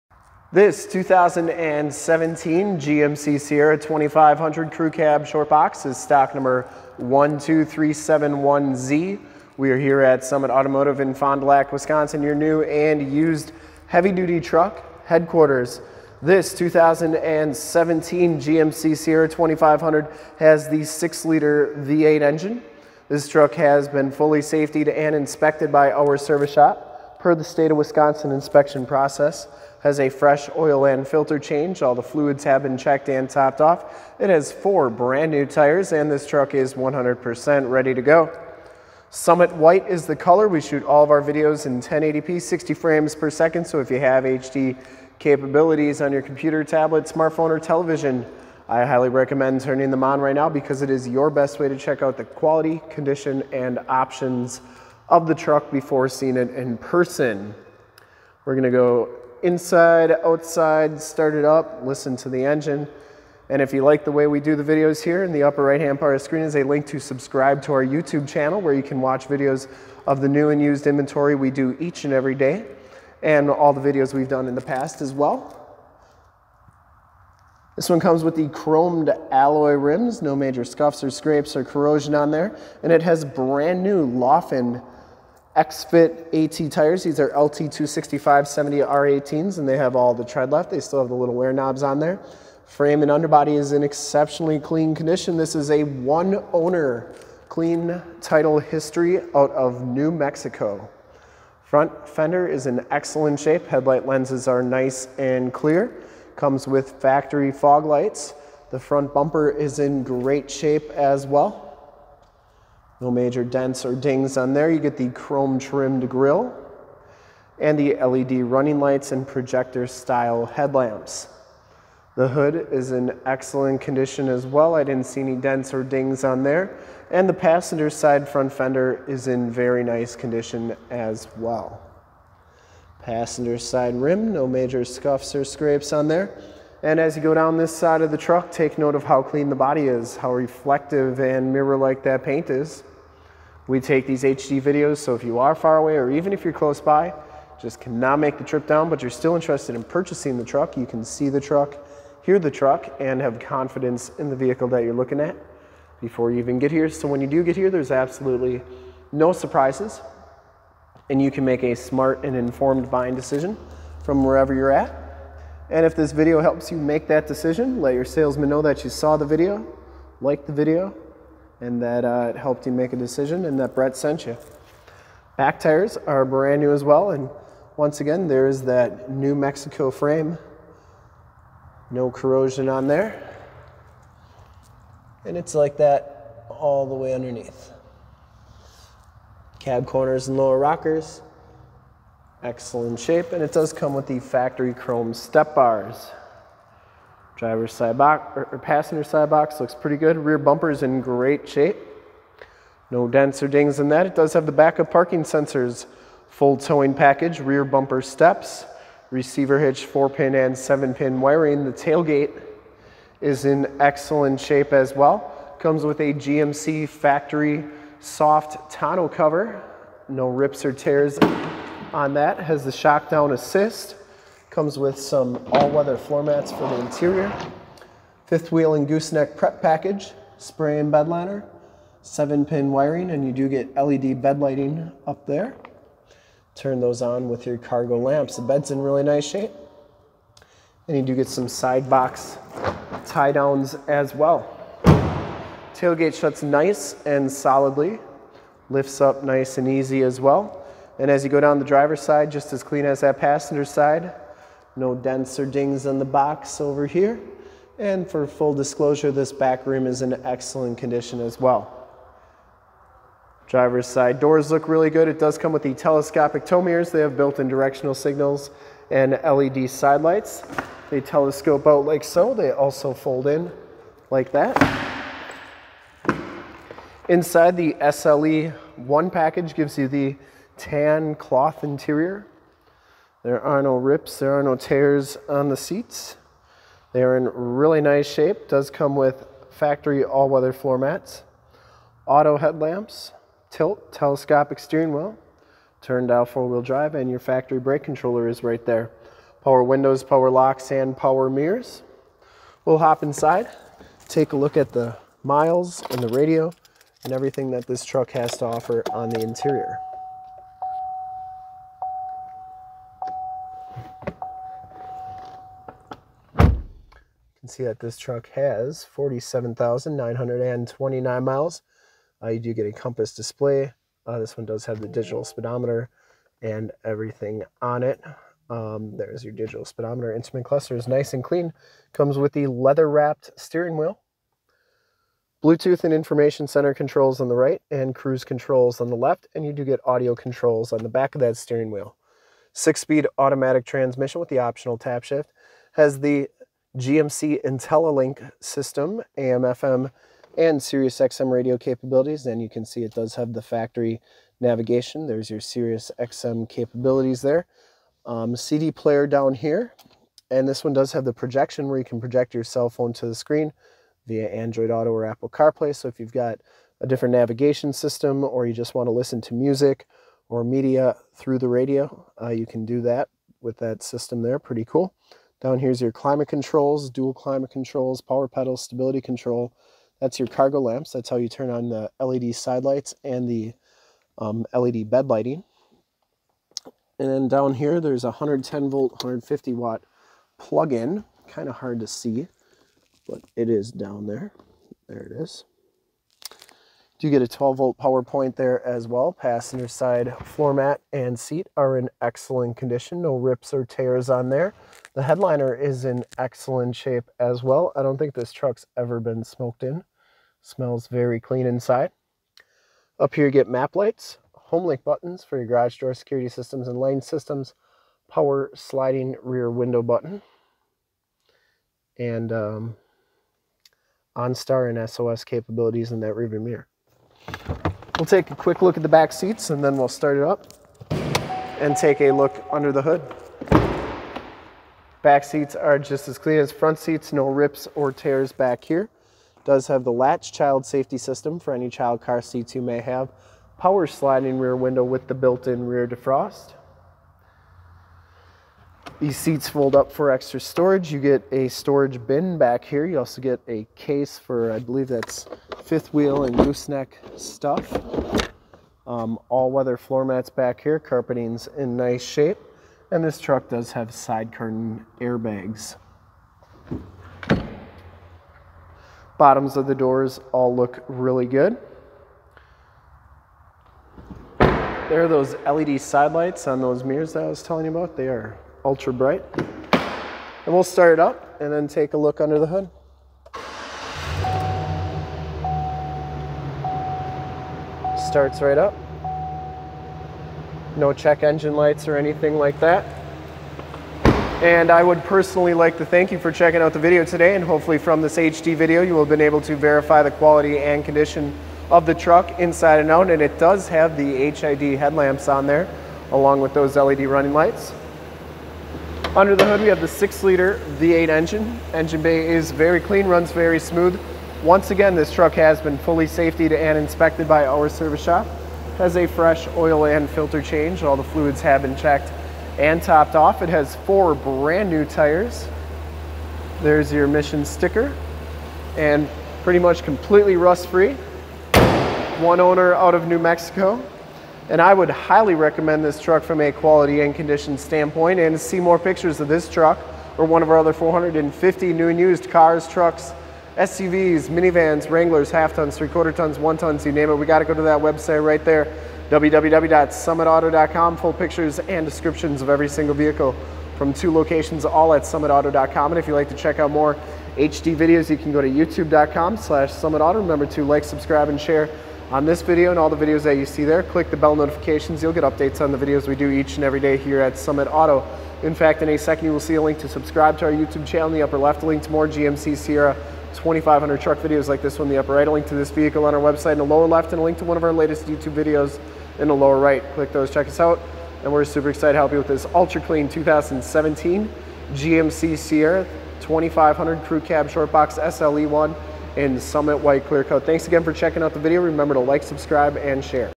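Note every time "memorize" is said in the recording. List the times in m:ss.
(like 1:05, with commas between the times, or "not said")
not said.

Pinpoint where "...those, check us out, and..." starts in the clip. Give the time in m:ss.
9:40.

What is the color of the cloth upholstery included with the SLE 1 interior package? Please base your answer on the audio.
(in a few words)
tan.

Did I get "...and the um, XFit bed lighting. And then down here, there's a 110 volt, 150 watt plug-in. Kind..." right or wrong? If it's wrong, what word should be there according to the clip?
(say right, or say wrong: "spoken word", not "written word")
wrong: "LED", not "XFit".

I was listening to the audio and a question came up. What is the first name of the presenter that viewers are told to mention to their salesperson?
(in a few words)
Brett.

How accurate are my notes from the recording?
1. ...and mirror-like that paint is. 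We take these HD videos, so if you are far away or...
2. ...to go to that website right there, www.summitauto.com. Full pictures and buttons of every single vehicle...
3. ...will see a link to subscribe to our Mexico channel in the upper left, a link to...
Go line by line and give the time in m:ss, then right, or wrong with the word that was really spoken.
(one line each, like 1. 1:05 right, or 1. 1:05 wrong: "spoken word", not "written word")
1. 2:21 right
2. 9:07 wrong: "descriptions", not "buttons"
3. 9:29 wrong: "YouTube", not "Mexico".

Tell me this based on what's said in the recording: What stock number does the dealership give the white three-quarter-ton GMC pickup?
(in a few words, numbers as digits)
12371Z.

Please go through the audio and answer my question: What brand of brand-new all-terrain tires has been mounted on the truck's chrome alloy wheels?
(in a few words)
Laufenn.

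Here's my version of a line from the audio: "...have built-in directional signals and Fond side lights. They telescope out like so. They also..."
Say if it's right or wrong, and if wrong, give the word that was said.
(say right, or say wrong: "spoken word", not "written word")
wrong: "LED", not "Fond".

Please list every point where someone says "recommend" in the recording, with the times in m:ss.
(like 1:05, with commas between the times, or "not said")
0:49, 8:55.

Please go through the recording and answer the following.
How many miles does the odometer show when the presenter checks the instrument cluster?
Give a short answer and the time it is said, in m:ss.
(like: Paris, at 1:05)
47,929, at 5:18.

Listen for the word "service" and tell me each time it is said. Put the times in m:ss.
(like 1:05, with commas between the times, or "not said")
0:26, 8:37.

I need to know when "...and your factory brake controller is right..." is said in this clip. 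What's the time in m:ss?
4:56.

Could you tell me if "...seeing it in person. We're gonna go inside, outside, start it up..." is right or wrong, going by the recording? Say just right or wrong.
right.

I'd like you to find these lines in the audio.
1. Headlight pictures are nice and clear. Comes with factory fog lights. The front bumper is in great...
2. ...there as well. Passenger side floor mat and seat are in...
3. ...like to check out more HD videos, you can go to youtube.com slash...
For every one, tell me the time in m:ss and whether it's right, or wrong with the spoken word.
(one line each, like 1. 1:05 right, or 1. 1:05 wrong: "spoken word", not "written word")
1. 1:43 wrong: "lenses", not "pictures"
2. 6:38 right
3. 9:16 right.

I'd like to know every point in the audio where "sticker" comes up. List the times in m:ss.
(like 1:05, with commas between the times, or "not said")
8:47.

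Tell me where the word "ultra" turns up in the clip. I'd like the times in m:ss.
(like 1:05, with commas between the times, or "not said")
7:58, 9:42.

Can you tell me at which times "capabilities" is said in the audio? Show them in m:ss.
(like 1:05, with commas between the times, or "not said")
0:45, 5:51, 5:56, 7:05.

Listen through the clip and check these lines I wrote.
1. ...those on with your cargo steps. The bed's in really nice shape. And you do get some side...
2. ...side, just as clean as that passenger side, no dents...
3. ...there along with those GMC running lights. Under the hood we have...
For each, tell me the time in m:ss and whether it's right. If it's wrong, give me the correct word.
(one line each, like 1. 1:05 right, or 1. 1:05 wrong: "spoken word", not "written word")
1. 3:56 wrong: "lamps", not "steps"
2. 4:12 right
3. 8:25 wrong: "LED", not "GMC".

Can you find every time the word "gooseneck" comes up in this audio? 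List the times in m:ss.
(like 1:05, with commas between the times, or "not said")
3:48, 7:36.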